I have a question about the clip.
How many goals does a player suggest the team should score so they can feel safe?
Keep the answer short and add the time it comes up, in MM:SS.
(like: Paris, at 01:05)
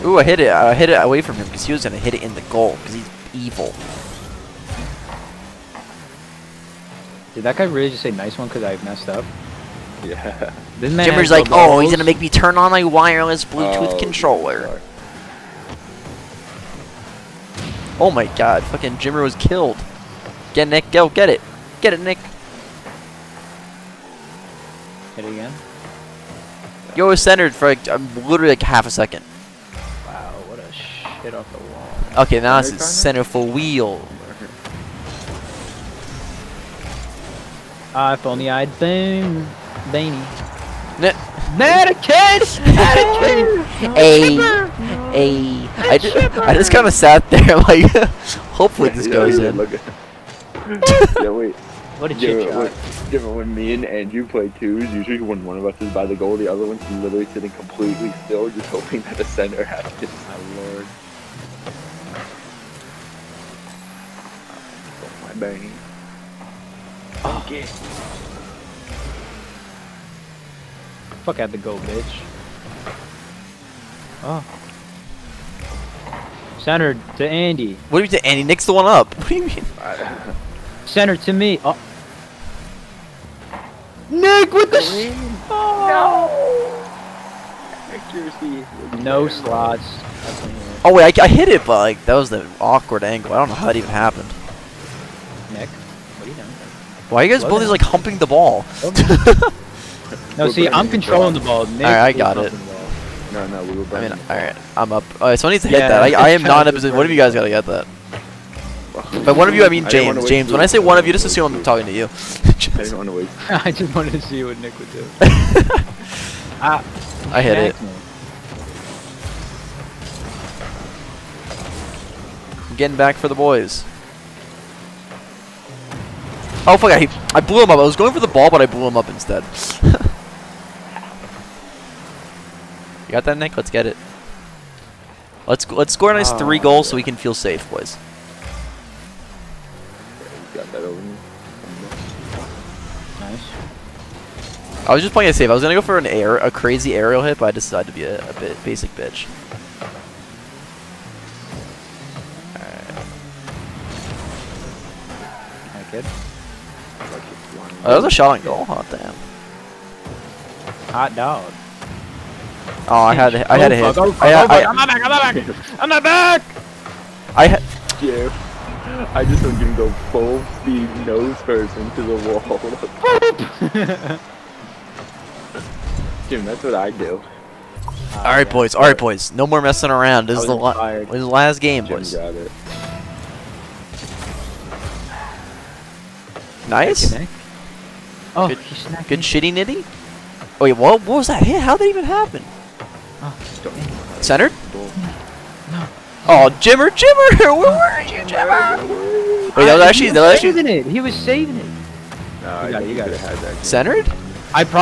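3, at 02:16.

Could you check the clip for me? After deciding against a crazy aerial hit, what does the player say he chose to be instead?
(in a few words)
basic bitch.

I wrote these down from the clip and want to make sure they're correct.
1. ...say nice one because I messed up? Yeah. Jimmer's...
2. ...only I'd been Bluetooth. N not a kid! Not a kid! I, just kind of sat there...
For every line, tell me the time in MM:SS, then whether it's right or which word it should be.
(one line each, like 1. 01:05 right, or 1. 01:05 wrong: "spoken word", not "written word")
1. 00:08 right
2. 00:38 wrong: "Baney", not "Bluetooth".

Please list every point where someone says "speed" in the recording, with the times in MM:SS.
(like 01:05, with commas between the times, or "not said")
02:50.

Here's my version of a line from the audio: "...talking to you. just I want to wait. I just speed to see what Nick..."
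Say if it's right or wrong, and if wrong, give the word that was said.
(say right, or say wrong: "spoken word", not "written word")
wrong: "wanted", not "speed".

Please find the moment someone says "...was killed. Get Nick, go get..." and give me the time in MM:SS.
00:19.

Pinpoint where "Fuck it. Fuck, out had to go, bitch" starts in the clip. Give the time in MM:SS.
01:07.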